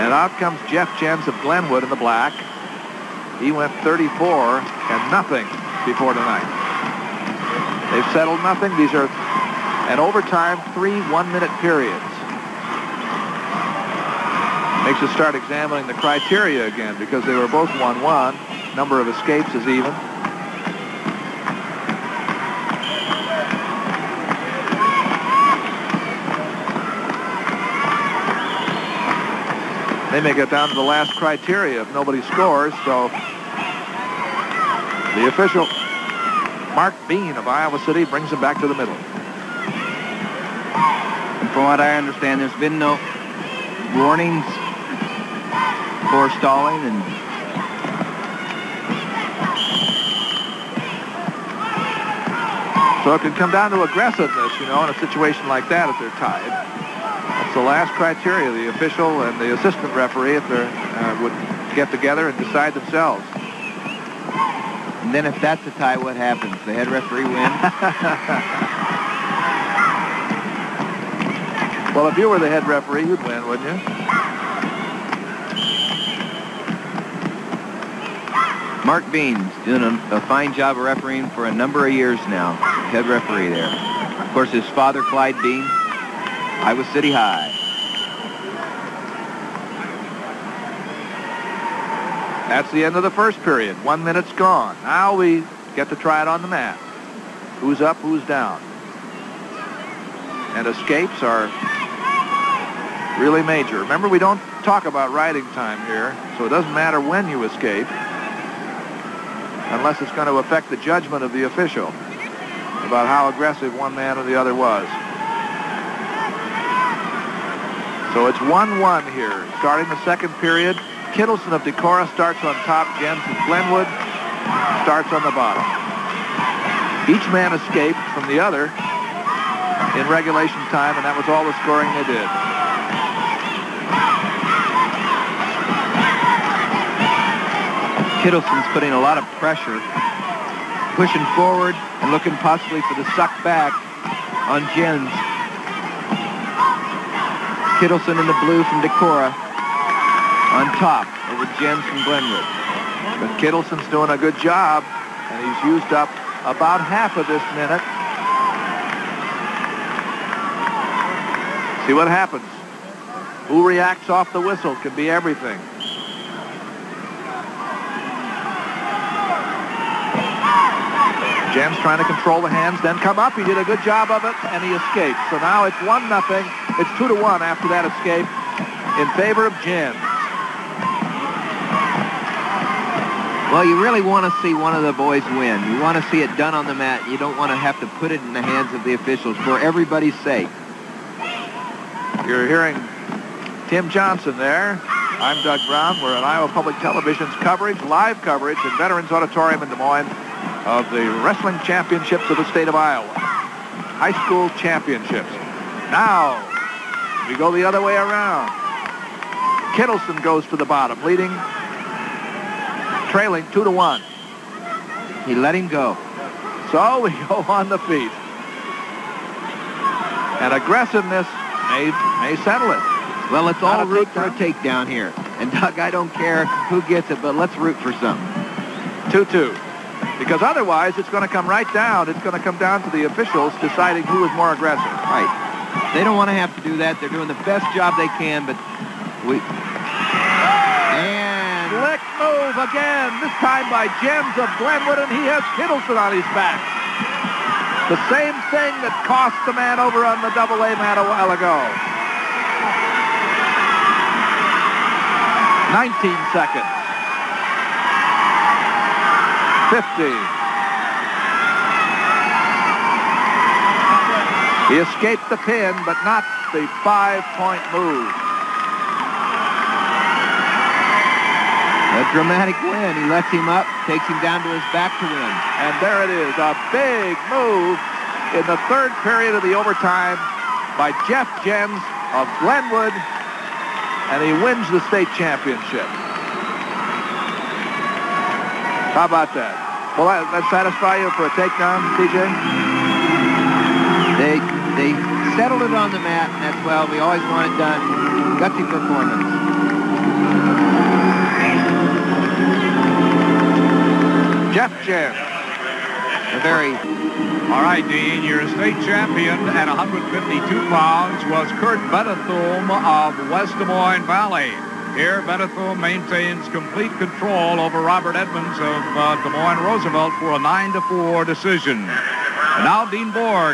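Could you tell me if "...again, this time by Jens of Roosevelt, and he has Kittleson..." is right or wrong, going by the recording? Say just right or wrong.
wrong.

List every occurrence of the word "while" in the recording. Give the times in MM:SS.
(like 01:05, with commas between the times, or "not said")
04:11.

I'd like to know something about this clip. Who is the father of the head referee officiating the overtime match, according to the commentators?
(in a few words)
Clyde Beans.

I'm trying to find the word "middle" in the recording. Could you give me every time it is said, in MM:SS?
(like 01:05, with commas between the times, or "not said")
00:38.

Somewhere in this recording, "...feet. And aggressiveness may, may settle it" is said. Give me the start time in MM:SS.
03:37.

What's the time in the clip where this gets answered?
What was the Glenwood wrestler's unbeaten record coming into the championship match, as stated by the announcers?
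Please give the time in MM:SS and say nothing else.
00:03.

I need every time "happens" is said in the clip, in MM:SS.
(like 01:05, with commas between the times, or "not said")
01:06, 02:42.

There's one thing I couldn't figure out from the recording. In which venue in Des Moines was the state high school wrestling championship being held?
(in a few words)
Veterans Auditorium.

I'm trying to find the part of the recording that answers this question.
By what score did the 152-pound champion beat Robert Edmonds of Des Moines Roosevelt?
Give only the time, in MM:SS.
05:20.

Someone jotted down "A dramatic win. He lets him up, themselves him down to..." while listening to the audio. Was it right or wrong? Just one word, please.
wrong.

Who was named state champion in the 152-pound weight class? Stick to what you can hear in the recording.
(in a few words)
Kurt Bennethum.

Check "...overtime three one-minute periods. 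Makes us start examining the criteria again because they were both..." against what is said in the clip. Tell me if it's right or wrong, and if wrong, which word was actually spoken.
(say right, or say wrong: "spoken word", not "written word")
right.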